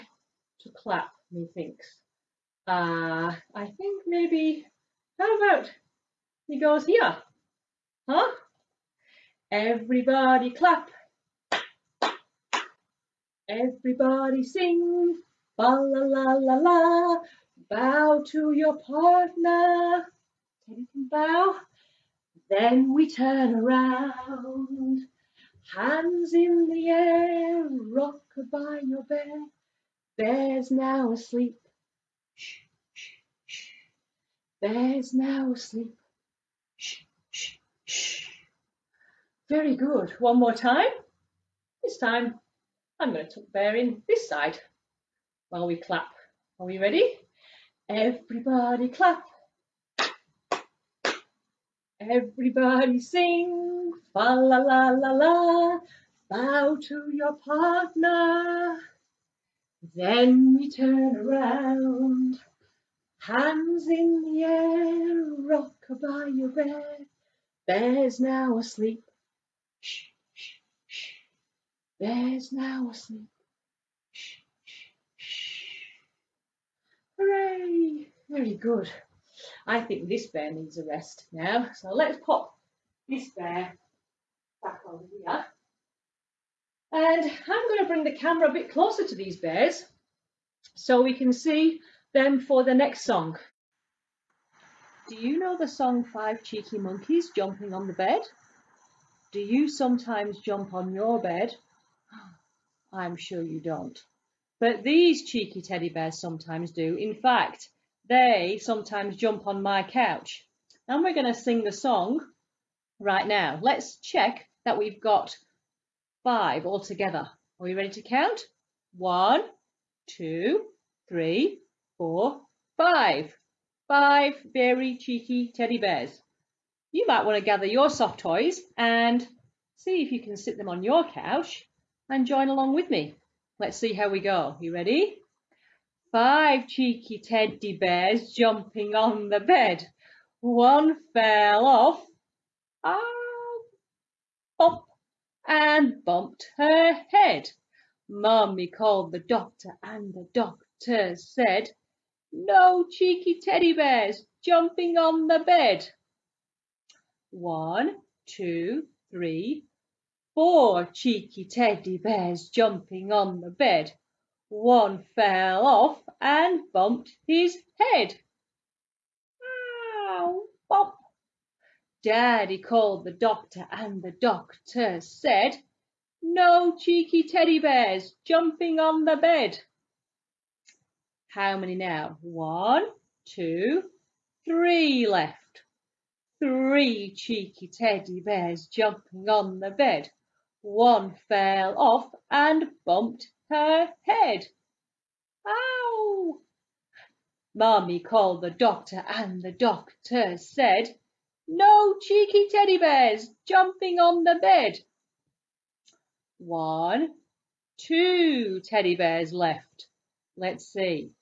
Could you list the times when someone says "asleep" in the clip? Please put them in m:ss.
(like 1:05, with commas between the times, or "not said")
0:31, 0:35, 1:08.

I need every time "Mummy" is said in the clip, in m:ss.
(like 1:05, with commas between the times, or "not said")
2:28, 3:17.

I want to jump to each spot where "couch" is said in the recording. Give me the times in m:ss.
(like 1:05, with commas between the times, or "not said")
1:49, 2:11.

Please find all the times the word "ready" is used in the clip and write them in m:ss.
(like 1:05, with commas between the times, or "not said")
0:46, 1:57, 2:14.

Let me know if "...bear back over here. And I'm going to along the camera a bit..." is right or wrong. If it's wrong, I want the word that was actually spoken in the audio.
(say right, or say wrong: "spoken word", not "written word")
wrong: "bring", not "along".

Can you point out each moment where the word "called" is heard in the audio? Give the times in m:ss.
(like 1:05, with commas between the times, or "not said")
2:28, 2:52, 3:17.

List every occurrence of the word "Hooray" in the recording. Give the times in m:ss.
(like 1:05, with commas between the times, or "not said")
1:17.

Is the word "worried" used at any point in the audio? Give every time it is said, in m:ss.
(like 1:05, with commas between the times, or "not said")
not said.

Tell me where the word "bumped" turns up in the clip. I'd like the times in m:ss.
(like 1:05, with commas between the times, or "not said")
2:26, 2:46, 3:12.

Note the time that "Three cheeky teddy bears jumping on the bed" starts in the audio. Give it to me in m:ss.
3:06.